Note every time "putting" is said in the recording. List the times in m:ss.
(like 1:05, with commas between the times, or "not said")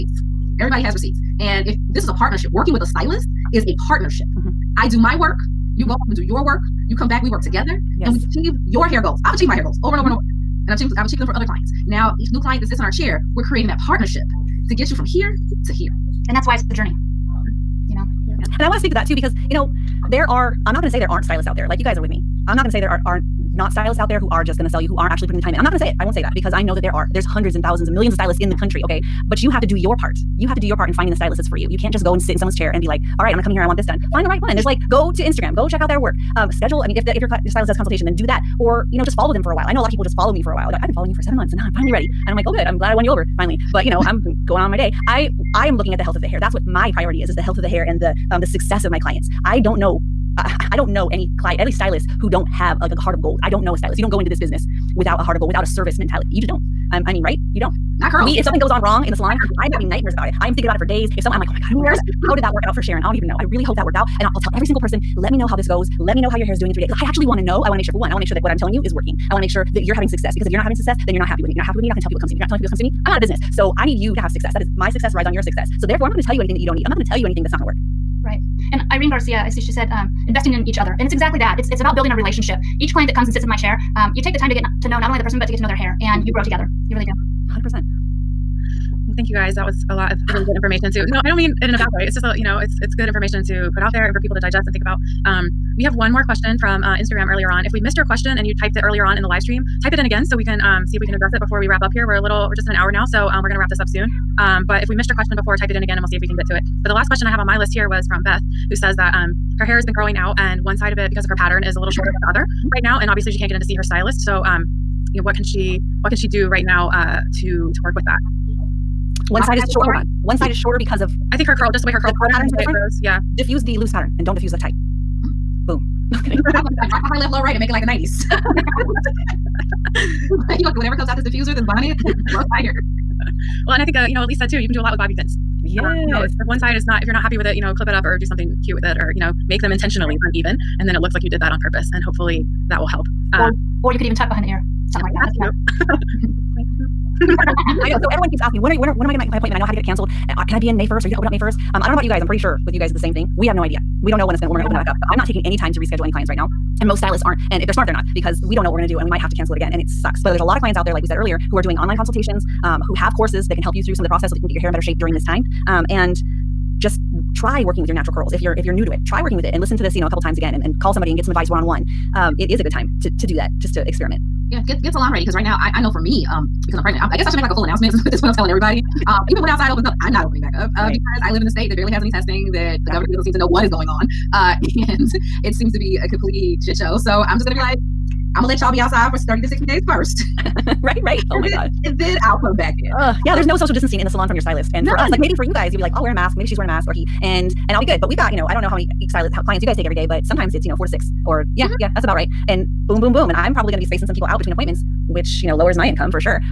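0:25.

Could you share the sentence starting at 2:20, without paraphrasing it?
And then it looks like you did that on purpose.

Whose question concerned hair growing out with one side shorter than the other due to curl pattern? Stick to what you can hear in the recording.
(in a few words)
Beth.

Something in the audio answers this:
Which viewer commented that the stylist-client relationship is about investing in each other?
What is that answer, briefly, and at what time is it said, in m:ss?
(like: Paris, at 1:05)
Irene Garcia, at 1:18.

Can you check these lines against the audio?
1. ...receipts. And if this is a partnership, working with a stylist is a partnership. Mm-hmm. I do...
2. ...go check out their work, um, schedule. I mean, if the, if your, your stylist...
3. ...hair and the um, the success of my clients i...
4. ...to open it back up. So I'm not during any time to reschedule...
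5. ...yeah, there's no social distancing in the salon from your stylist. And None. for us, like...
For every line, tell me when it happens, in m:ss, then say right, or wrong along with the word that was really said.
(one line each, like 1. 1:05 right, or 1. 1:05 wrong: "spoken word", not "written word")
1. 0:00 right
2. 0:35 right
3. 0:47 right
4. 2:34 wrong: "taking", not "during"
5. 3:13 right.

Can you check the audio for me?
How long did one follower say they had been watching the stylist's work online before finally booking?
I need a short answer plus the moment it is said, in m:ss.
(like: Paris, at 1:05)
7 months, at 0:41.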